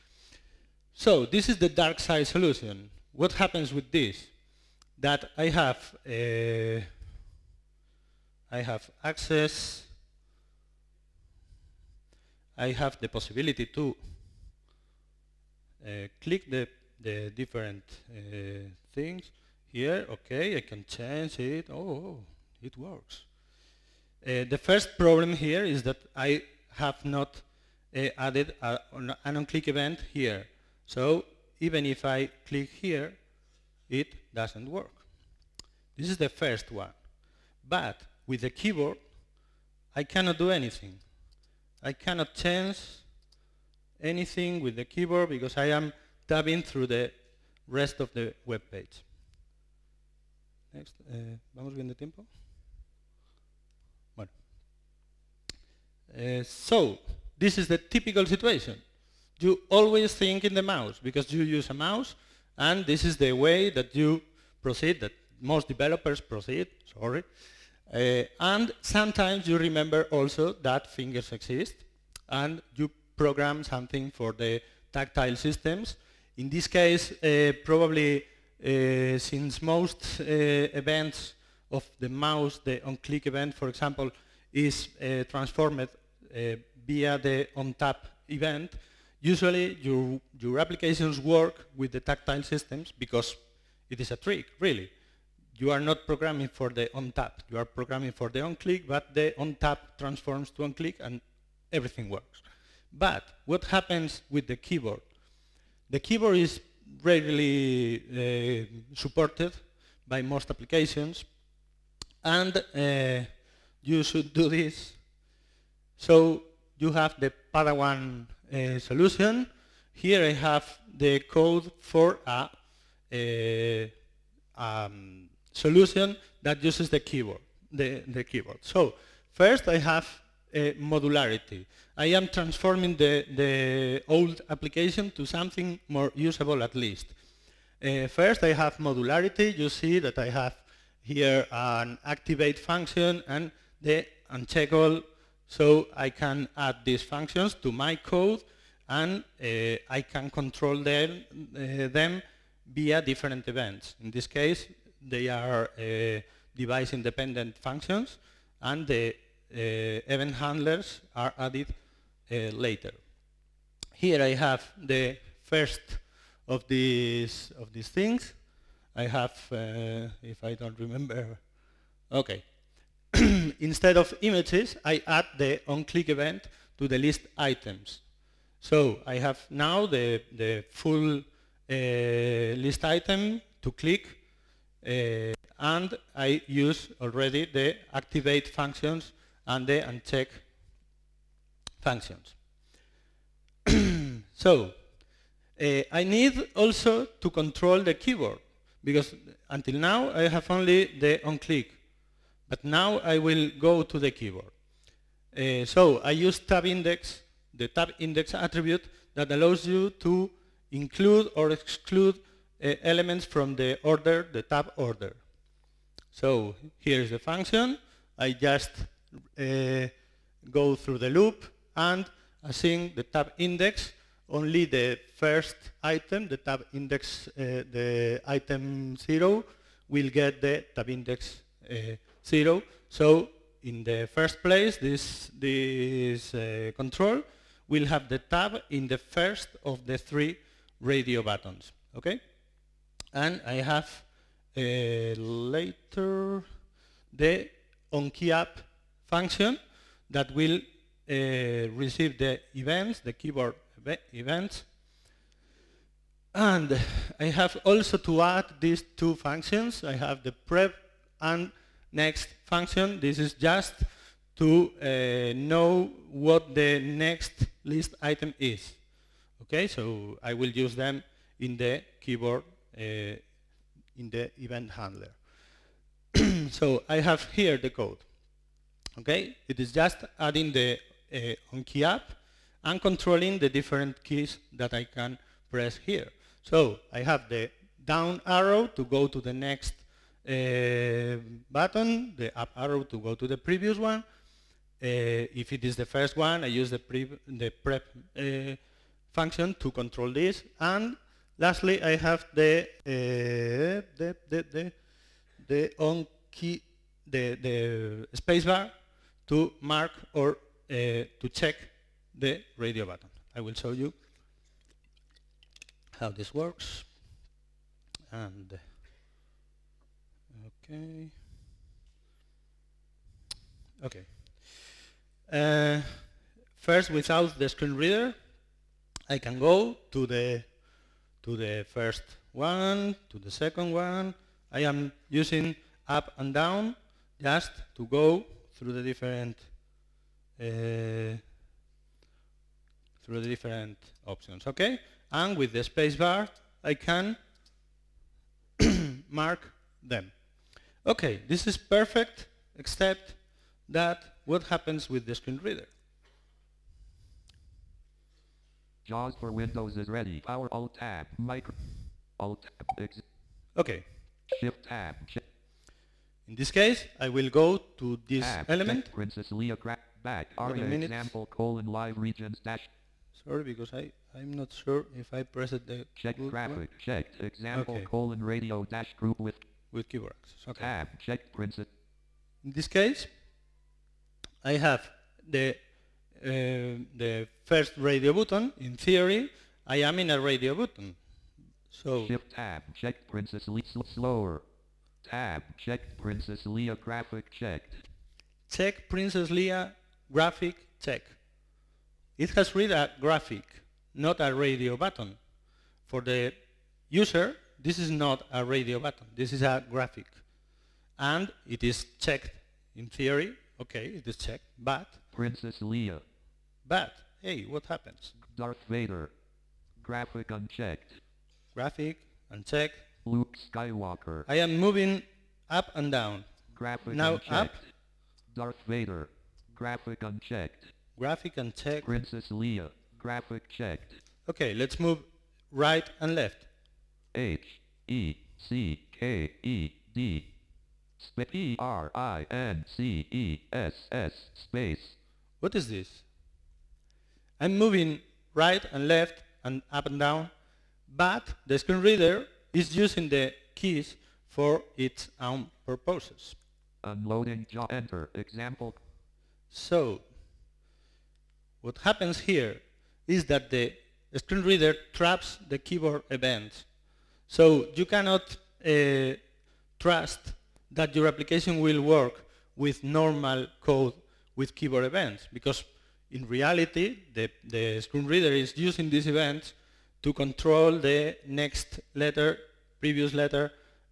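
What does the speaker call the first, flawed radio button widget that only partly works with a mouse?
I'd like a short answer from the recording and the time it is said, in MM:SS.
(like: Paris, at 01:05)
Dark side solution, at 00:01.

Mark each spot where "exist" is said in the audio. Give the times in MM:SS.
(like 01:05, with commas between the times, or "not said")
01:11.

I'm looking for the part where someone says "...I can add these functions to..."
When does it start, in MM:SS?
02:25.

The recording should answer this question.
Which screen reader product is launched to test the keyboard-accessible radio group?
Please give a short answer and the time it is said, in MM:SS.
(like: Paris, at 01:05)
JAWS for Windows, at 05:58.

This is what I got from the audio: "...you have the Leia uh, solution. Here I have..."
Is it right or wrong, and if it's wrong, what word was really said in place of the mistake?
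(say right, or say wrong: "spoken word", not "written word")
wrong: "Padawan", not "Leia".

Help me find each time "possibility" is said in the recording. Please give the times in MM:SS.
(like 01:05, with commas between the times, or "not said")
00:13.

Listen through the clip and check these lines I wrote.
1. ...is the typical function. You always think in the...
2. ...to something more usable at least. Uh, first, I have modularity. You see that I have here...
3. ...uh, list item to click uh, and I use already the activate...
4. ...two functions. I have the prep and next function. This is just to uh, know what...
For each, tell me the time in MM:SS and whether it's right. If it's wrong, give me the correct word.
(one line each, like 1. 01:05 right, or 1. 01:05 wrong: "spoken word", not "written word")
1. 00:57 wrong: "situation", not "function"
2. 02:15 right
3. 03:01 right
4. 04:18 right.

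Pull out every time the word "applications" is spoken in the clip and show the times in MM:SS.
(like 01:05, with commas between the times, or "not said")
01:30, 01:50, 02:14, 07:51.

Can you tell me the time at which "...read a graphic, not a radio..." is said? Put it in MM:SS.
06:42.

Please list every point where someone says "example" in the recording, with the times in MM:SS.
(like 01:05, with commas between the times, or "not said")
01:23, 06:10, 06:17, 07:38.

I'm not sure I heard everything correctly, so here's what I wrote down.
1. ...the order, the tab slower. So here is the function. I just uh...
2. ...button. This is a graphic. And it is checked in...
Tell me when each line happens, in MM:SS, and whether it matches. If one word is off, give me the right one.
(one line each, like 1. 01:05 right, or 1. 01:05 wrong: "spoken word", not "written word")
1. 03:33 wrong: "order", not "slower"
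2. 06:48 right.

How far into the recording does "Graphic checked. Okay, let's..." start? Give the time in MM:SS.
07:12.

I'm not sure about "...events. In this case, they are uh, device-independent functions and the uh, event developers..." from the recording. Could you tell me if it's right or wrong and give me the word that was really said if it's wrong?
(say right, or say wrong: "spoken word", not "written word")
wrong: "handlers", not "developers".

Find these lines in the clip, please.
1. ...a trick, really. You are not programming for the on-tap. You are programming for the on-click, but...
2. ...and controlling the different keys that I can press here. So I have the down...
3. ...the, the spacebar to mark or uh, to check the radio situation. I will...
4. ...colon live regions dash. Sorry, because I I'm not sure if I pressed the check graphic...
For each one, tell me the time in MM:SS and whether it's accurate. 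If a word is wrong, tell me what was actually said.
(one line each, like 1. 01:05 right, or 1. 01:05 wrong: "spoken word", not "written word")
1. 01:34 right
2. 04:42 right
3. 05:07 wrong: "button", not "situation"
4. 06:11 right.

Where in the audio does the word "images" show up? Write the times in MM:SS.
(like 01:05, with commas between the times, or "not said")
02:54.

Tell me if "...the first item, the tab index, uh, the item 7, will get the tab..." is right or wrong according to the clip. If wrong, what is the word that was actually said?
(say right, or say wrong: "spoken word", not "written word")
wrong: "0", not "7".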